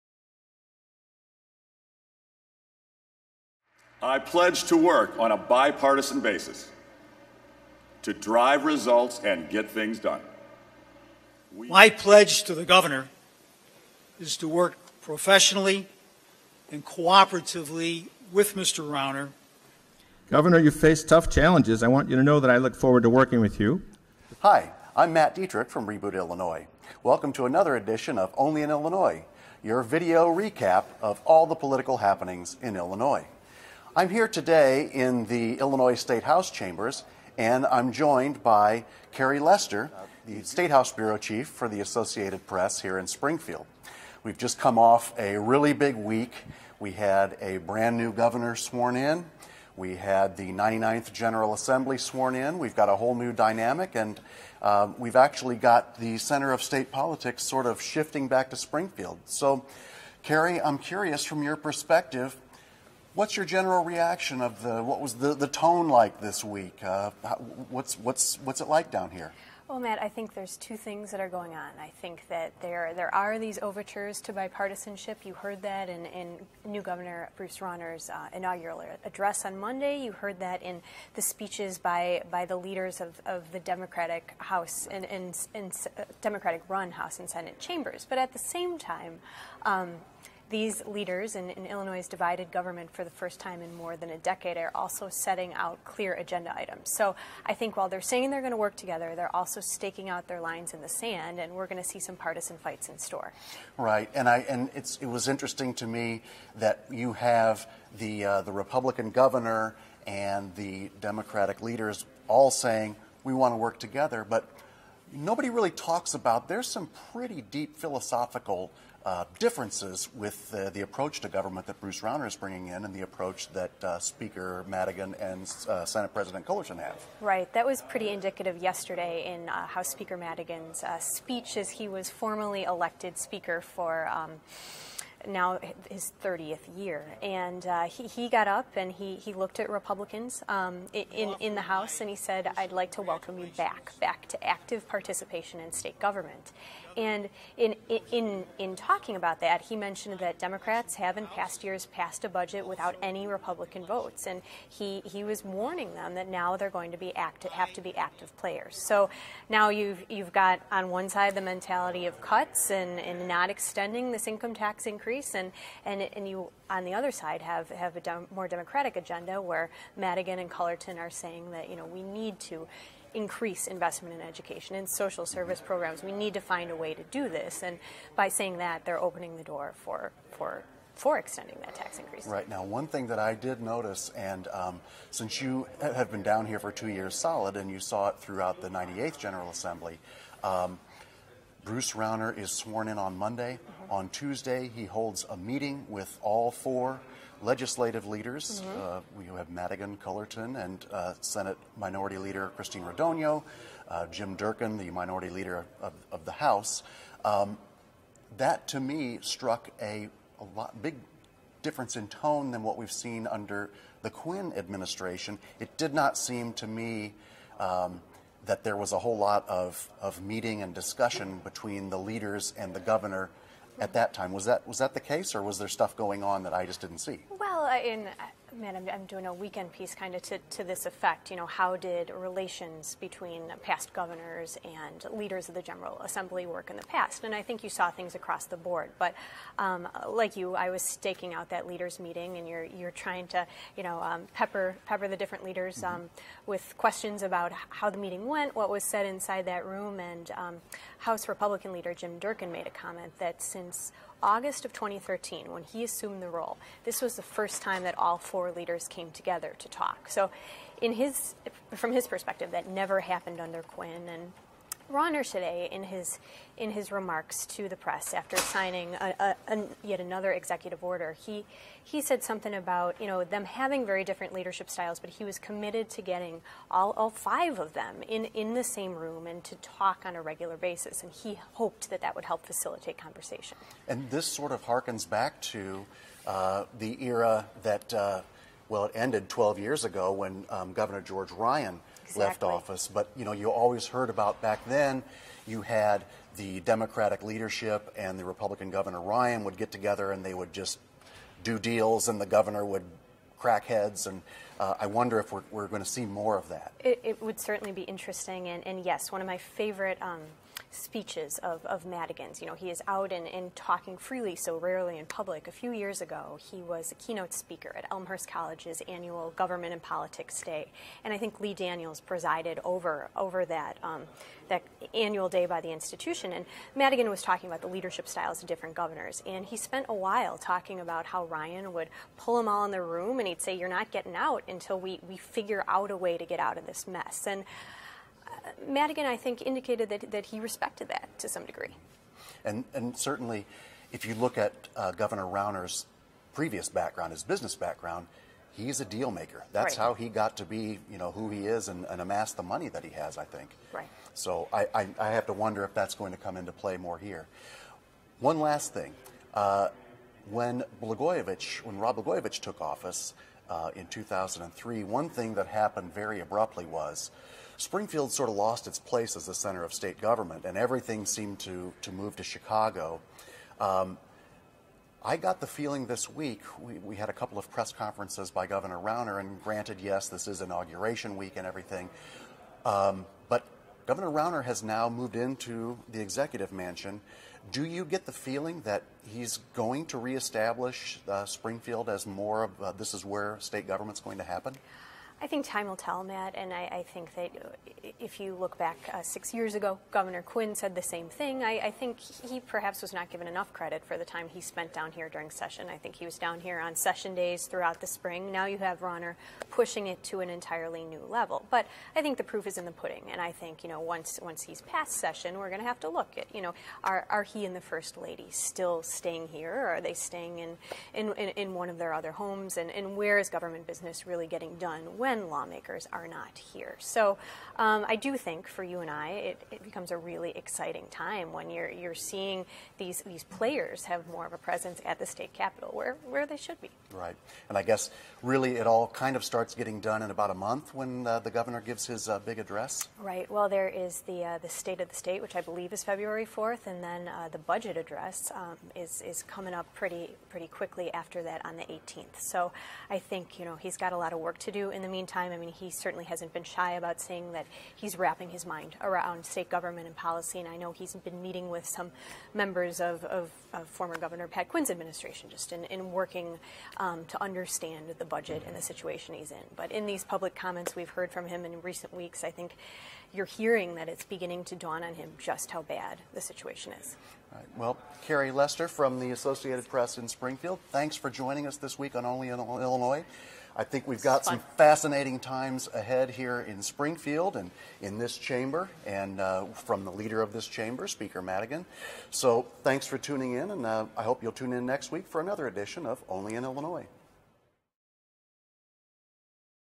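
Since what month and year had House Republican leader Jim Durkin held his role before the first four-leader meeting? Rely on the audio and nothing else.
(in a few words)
August 2013.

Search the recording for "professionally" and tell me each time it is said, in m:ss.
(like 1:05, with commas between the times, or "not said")
0:15.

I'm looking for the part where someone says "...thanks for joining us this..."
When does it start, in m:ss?
8:00.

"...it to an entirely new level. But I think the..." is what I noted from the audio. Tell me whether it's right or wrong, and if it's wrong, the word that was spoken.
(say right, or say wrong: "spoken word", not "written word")
right.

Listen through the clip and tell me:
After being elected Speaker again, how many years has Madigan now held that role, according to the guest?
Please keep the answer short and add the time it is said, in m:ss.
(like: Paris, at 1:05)
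30th year, at 2:16.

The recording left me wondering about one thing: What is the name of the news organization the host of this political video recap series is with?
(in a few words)
Reboot Illinois.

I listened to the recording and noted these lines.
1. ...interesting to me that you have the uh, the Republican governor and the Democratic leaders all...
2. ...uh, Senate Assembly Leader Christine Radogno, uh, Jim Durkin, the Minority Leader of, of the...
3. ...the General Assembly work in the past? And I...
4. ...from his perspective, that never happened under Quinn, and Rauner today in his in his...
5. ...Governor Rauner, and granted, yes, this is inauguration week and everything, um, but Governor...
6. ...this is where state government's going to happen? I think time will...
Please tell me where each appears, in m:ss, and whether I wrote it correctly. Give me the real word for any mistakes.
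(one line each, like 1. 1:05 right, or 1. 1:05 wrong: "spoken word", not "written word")
1. 1:45 right
2. 3:20 wrong: "Minority", not "Assembly"
3. 3:55 right
4. 4:21 right
5. 6:18 right
6. 6:32 right.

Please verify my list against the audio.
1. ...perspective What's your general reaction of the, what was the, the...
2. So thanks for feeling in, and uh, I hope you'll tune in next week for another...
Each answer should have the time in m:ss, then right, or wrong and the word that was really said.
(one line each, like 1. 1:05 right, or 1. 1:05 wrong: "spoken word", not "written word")
1. 1:01 right
2. 8:12 wrong: "tuning", not "feeling".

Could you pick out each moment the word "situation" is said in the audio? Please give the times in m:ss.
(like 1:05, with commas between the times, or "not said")
7:48, 7:56.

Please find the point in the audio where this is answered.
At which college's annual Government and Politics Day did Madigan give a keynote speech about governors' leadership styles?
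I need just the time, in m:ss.
5:17.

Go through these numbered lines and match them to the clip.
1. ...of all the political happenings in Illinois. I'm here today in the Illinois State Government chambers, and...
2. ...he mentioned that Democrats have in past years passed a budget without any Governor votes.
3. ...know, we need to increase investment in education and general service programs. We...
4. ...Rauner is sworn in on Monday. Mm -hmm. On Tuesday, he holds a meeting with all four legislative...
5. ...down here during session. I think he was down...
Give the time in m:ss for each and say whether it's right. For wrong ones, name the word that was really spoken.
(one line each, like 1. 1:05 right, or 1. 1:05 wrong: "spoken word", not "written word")
1. 0:31 wrong: "House", not "Government"
2. 2:29 wrong: "Republican", not "Governor"
3. 2:51 wrong: "social", not "general"
4. 3:11 right
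5. 6:44 right.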